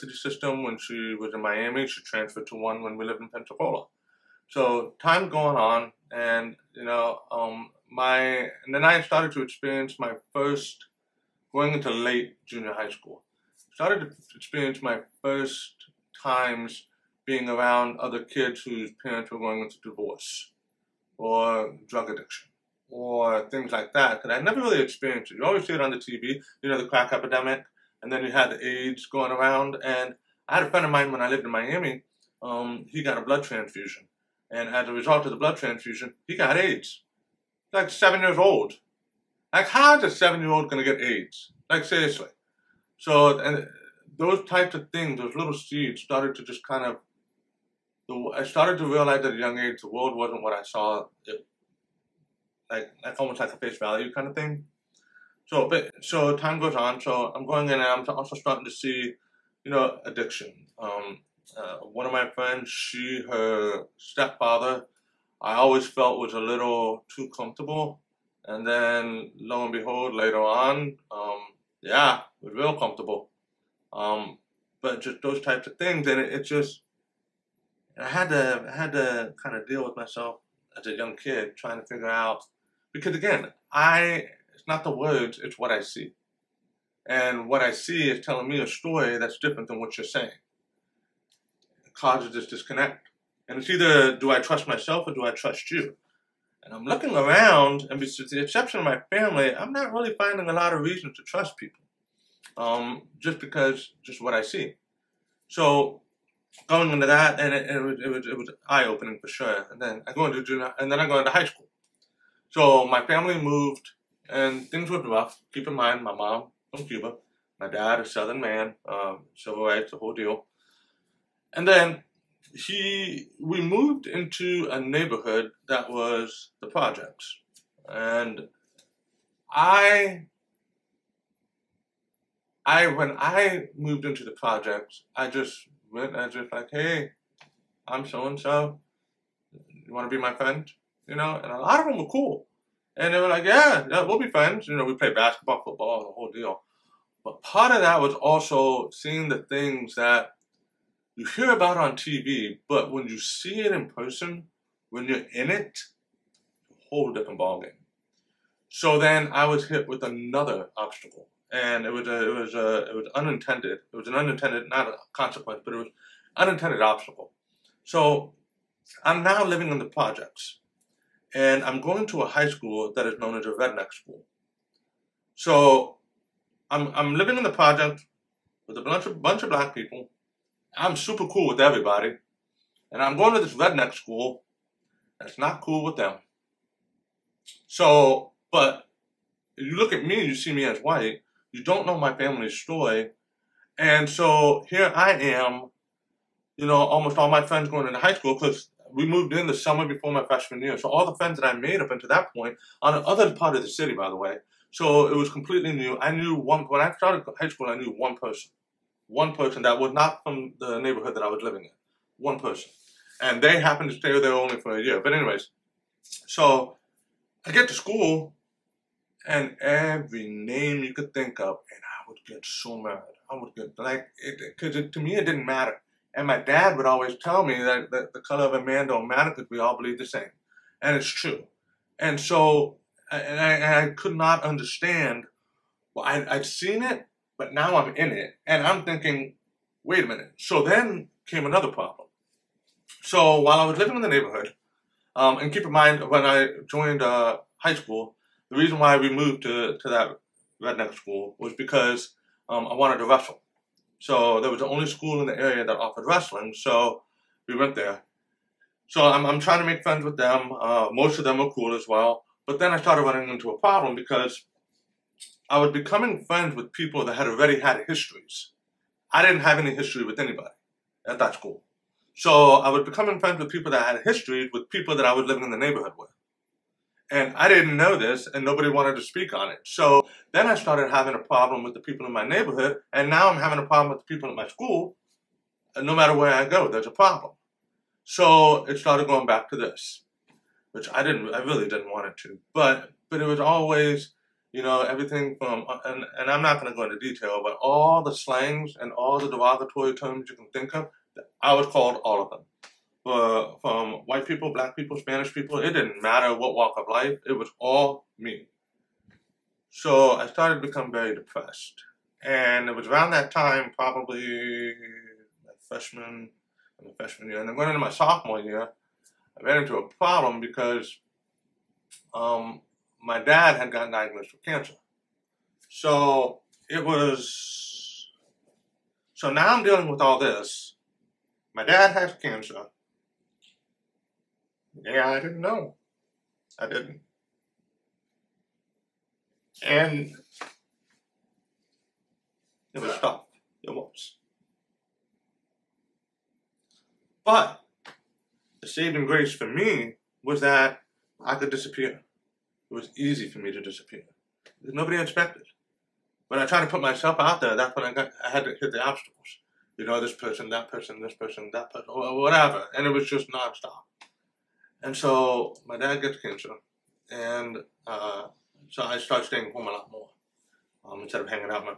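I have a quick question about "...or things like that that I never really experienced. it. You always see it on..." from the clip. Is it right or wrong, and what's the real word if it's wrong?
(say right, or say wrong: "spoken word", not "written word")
right.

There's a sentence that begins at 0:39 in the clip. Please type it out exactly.
Like how's a seven year old gonna get AIDS?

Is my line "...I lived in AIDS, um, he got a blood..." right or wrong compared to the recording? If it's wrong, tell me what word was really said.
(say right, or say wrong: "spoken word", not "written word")
wrong: "Miami", not "AIDS".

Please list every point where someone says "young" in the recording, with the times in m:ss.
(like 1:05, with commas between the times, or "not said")
0:49, 1:20.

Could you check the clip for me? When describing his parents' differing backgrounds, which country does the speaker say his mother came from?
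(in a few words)
Cuba.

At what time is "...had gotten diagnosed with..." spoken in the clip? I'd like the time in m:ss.
5:23.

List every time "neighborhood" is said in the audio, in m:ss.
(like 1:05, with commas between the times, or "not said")
2:04, 3:30, 4:04, 4:35, 4:42.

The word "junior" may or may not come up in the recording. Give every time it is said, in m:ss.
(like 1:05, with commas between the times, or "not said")
0:12, 1:50.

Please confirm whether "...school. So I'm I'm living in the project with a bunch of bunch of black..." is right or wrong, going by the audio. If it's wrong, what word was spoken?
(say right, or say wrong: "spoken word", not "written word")
right.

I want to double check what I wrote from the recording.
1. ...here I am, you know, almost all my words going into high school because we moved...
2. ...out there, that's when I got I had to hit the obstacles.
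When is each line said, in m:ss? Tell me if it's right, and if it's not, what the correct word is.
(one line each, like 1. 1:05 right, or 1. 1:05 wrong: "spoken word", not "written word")
1. 3:14 wrong: "friends", not "words"
2. 5:57 right.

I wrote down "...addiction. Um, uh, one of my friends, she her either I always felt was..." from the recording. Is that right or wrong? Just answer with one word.
wrong.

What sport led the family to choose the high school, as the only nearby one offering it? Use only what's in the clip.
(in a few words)
Wrestling.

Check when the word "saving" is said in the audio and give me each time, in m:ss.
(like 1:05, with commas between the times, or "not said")
5:48.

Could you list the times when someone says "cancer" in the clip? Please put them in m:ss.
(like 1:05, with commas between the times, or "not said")
5:24, 5:32, 6:06.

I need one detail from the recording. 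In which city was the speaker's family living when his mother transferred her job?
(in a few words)
Pensacola.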